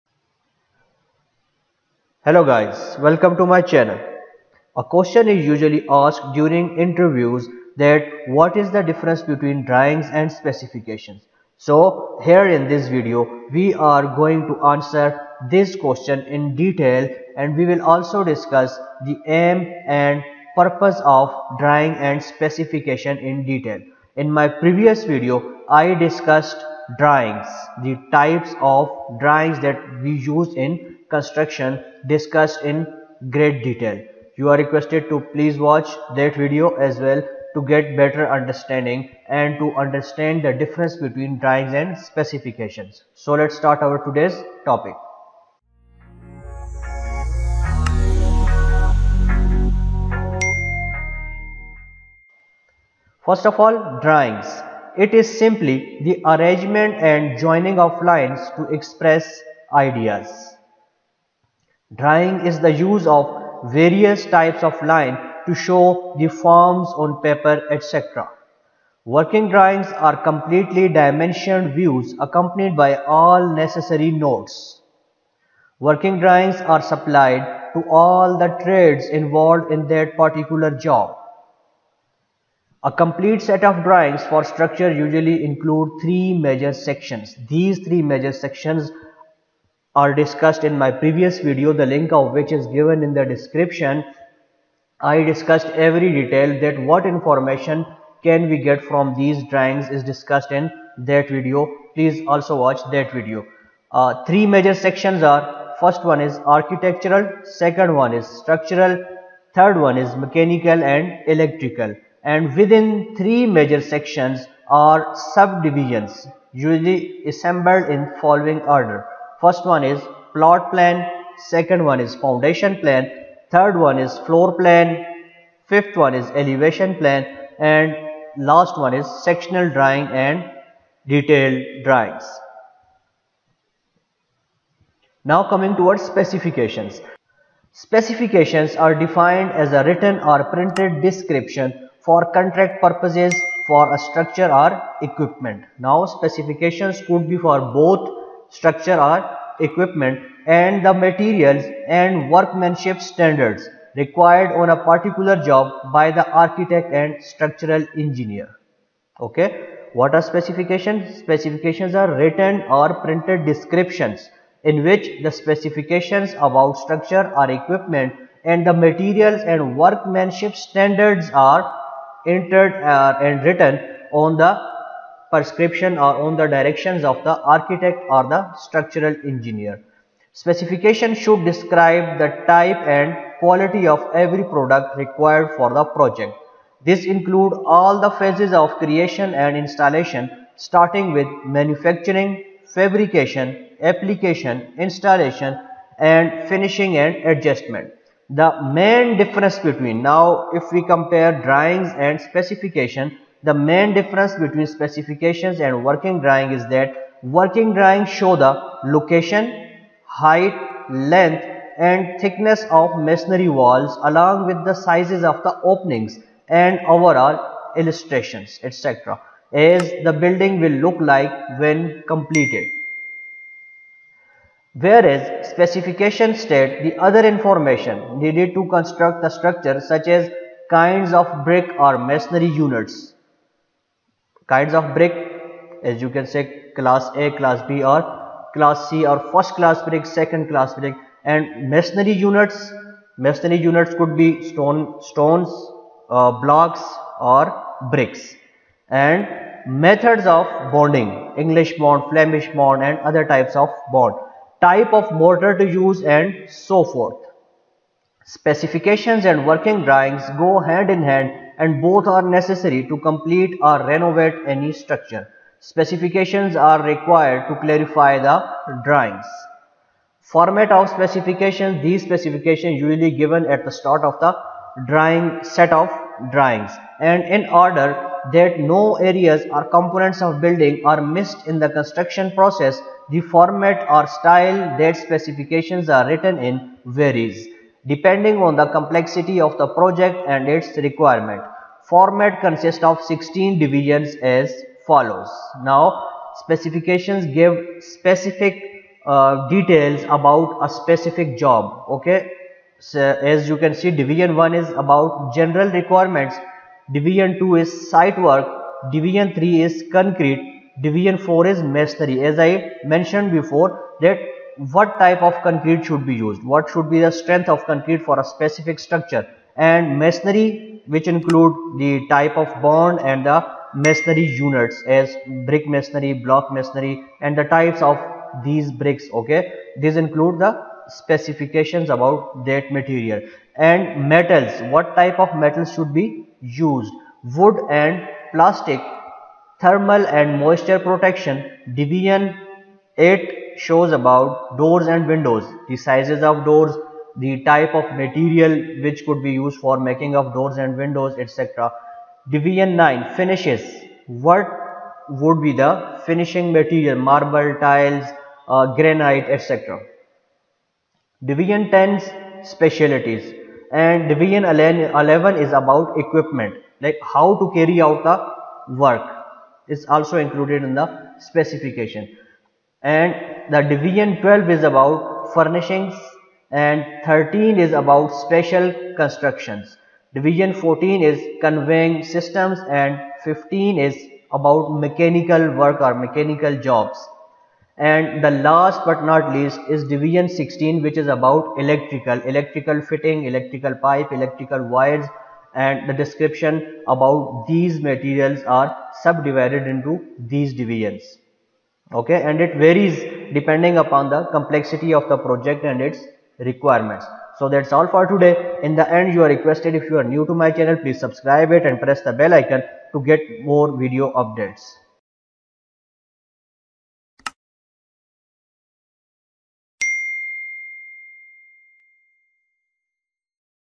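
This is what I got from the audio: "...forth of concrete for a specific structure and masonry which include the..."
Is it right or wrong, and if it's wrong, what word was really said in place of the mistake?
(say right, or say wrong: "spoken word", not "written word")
wrong: "strength", not "forth".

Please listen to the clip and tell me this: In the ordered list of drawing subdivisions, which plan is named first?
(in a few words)
Plot plan.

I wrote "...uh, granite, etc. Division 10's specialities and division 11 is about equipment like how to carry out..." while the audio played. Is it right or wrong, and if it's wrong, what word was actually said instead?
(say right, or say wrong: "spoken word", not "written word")
right.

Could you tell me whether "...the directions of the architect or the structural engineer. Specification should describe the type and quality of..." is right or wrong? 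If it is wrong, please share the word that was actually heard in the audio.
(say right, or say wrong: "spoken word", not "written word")
right.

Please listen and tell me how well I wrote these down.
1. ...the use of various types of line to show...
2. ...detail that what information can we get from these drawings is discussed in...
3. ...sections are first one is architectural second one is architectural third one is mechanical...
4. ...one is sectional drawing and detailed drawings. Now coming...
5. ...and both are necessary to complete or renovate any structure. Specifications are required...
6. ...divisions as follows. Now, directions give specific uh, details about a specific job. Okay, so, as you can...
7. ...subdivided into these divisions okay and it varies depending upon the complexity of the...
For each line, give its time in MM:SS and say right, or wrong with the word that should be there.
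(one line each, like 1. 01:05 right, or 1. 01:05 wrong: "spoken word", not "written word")
1. 01:02 right
2. 01:36 right
3. 01:44 wrong: "structural", not "architectural"
4. 02:08 right
5. 04:21 right
6. 04:53 wrong: "specifications", not "directions"
7. 06:39 right.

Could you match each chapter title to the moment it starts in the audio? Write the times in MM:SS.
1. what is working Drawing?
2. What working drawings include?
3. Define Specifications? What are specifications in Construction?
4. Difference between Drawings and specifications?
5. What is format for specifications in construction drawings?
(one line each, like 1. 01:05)
1. 00:52
2. 01:21
3. 02:15
4. 03:17
5. 04:29.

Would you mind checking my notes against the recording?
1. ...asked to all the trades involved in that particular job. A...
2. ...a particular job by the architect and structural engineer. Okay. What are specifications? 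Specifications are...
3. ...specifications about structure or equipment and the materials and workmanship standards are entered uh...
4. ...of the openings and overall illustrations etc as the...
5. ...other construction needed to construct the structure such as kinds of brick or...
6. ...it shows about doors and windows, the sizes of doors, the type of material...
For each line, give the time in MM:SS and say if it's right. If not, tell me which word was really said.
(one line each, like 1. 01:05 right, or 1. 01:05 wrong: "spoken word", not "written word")
1. 01:16 wrong: "supplied", not "asked"
2. 02:34 right
3. 02:45 right
4. 03:35 right
5. 03:47 wrong: "information", not "construction"
6. 05:42 right.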